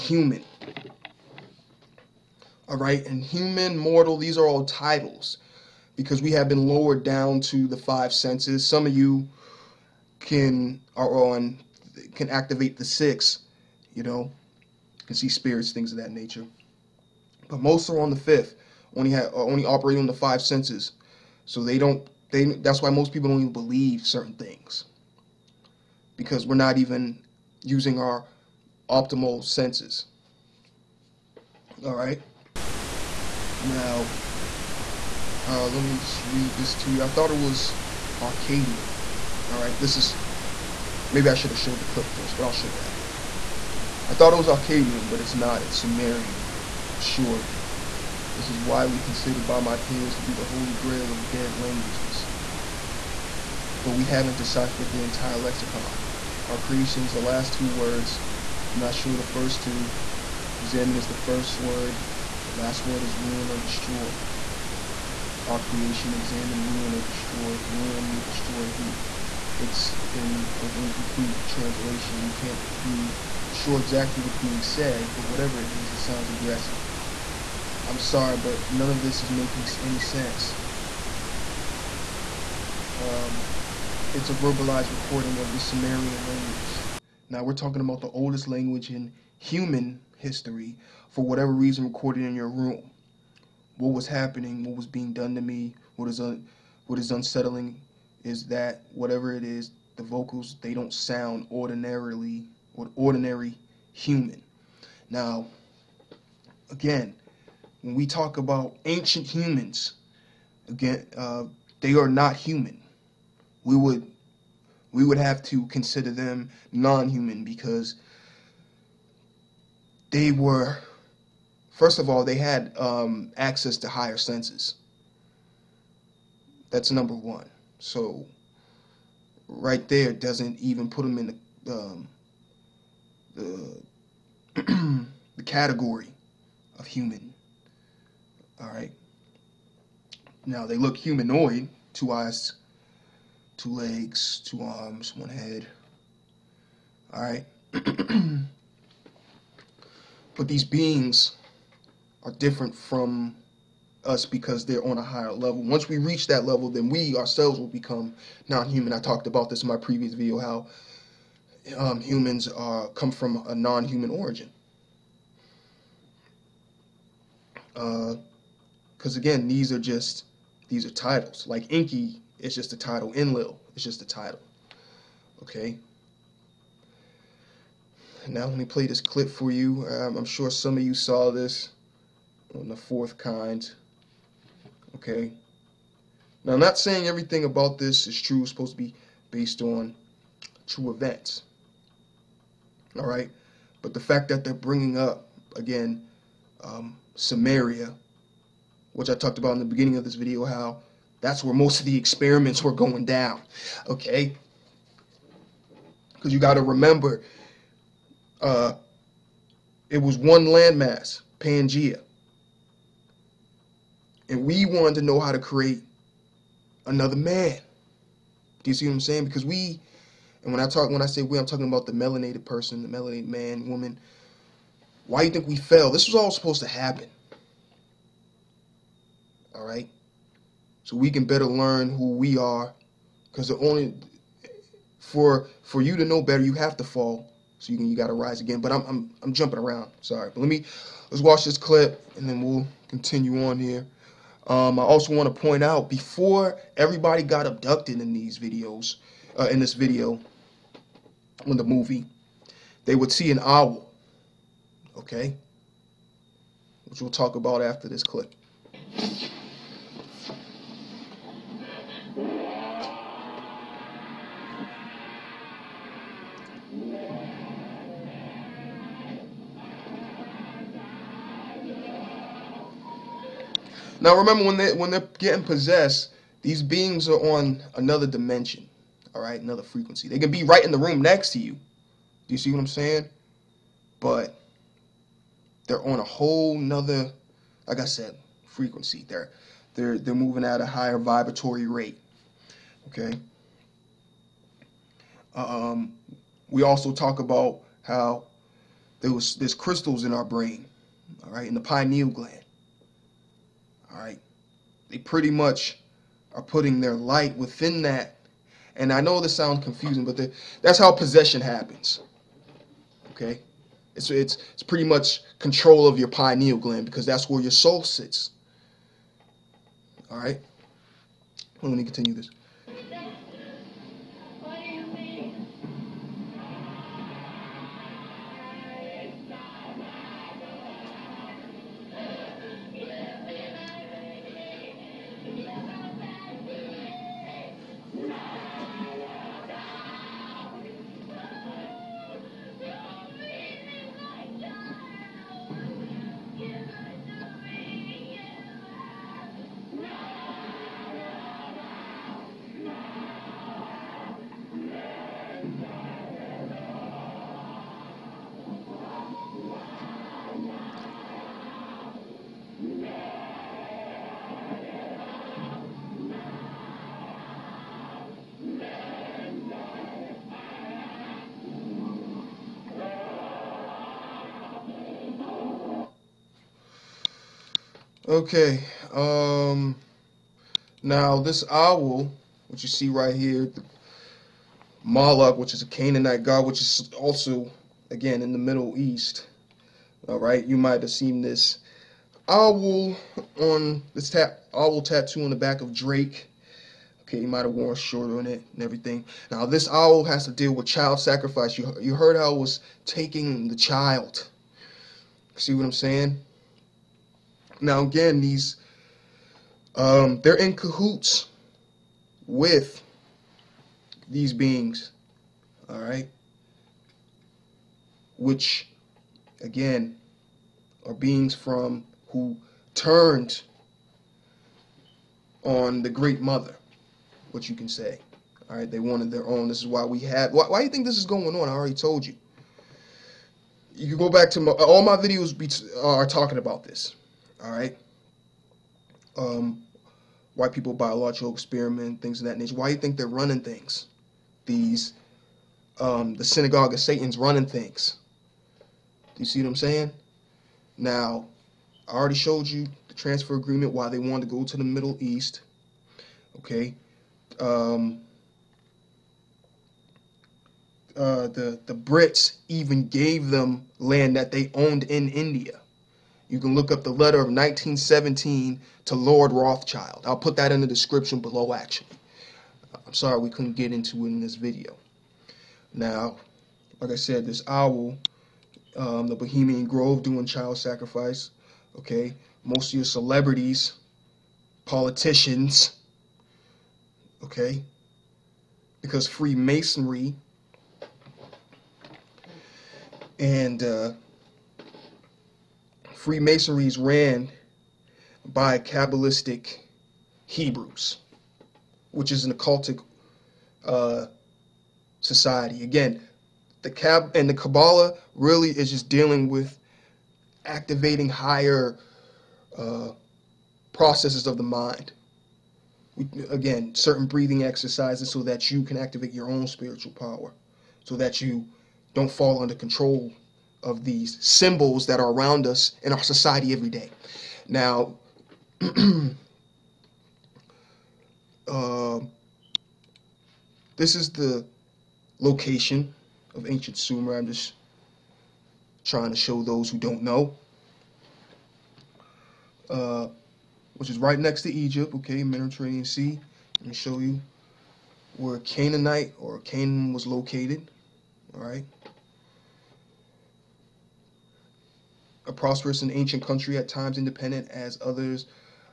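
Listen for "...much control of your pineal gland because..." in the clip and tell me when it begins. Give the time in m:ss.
5:14.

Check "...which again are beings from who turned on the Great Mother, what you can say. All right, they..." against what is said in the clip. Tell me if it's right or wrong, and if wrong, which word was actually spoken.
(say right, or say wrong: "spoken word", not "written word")
right.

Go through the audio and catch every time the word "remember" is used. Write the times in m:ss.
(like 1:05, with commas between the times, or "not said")
3:26, 4:34.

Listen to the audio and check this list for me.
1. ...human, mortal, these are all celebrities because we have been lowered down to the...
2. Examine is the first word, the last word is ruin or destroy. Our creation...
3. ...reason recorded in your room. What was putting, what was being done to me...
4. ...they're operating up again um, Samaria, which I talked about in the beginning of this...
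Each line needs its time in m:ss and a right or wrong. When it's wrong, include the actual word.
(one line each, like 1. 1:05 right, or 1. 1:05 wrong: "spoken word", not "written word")
1. 0:03 wrong: "titles", not "celebrities"
2. 1:00 right
3. 1:31 wrong: "happening", not "putting"
4. 3:14 wrong: "bringing", not "operating".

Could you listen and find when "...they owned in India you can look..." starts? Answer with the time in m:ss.
7:44.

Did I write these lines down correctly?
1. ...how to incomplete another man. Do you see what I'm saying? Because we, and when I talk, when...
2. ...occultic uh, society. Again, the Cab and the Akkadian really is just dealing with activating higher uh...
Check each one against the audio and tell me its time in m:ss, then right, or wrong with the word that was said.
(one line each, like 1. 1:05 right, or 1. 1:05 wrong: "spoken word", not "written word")
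1. 3:35 wrong: "create", not "incomplete"
2. 8:22 wrong: "Kabbalah", not "Akkadian".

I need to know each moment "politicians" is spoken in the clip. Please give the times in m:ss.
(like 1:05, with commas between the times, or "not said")
8:04.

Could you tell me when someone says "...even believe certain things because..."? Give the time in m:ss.
0:23.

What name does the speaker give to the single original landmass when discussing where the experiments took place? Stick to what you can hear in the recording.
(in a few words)
Pangea.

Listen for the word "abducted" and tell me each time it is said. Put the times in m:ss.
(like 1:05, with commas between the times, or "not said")
4:07.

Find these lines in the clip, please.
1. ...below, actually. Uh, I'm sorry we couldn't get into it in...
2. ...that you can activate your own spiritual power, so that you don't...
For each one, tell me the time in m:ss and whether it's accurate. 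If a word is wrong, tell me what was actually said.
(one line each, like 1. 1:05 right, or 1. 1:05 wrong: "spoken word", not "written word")
1. 7:51 right
2. 8:38 right.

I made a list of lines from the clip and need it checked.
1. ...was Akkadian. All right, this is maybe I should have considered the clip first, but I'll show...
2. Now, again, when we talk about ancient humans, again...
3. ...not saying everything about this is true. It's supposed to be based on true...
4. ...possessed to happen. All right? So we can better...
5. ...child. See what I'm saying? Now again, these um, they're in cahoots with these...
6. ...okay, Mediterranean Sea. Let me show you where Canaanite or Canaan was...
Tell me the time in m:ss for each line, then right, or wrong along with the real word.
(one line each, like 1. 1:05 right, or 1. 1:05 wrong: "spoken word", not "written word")
1. 0:37 wrong: "showed", not "considered"
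2. 1:45 right
3. 3:06 right
4. 3:46 wrong: "supposed", not "possessed"
5. 6:43 right
6. 9:04 right.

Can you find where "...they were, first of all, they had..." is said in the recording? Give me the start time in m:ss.
2:00.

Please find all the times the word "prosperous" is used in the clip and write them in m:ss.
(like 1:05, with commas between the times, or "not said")
9:15.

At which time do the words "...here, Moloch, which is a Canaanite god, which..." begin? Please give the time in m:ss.
6:23.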